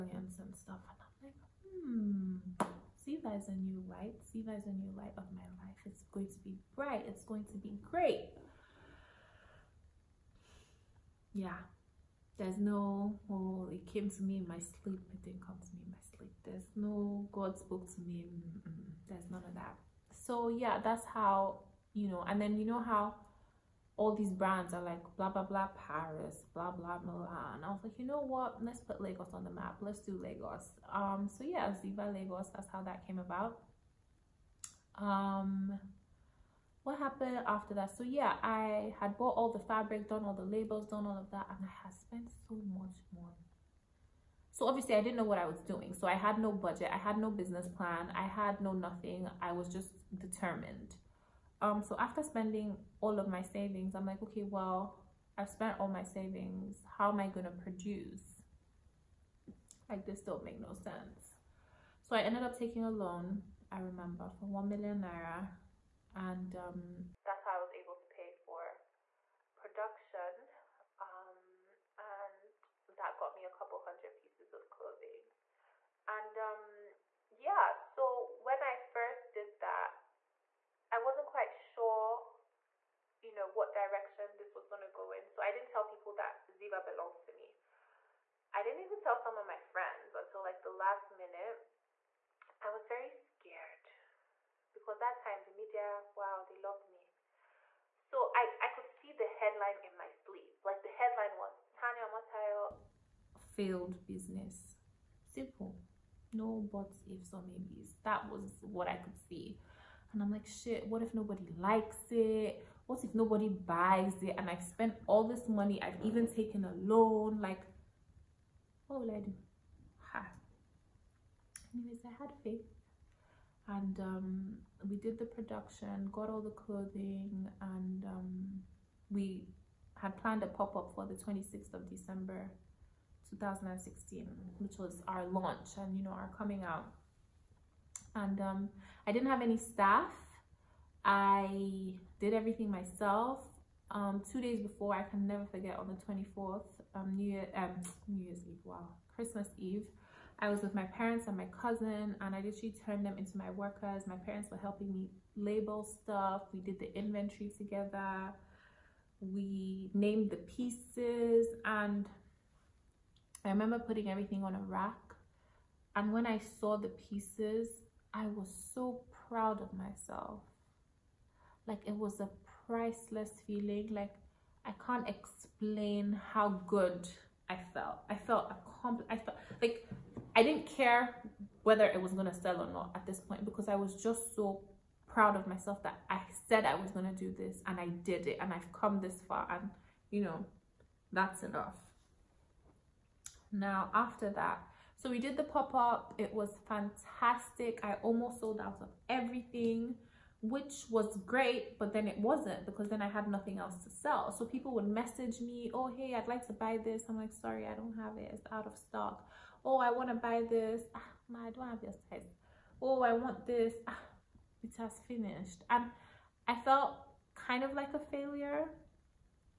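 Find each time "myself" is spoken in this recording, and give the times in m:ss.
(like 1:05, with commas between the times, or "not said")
2:22, 2:49, 3:05.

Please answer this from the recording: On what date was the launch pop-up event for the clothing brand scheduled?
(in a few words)
26 December 2016.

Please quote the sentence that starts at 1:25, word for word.
So I didn't tell people that Ziva belonged to me.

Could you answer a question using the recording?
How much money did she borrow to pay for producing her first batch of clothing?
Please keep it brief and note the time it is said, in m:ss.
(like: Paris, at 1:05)
1 million naira, at 1:04.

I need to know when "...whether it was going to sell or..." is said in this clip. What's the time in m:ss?
3:01.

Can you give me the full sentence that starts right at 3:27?
I'm like, sorry, I don't have it.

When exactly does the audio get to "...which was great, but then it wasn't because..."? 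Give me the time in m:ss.
3:20.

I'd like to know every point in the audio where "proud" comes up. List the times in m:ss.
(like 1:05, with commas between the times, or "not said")
2:49, 3:05.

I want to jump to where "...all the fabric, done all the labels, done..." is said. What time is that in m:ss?
0:39.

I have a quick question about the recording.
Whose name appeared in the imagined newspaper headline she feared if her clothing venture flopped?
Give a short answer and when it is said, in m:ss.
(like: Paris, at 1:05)
Tania Omotayo, at 1:41.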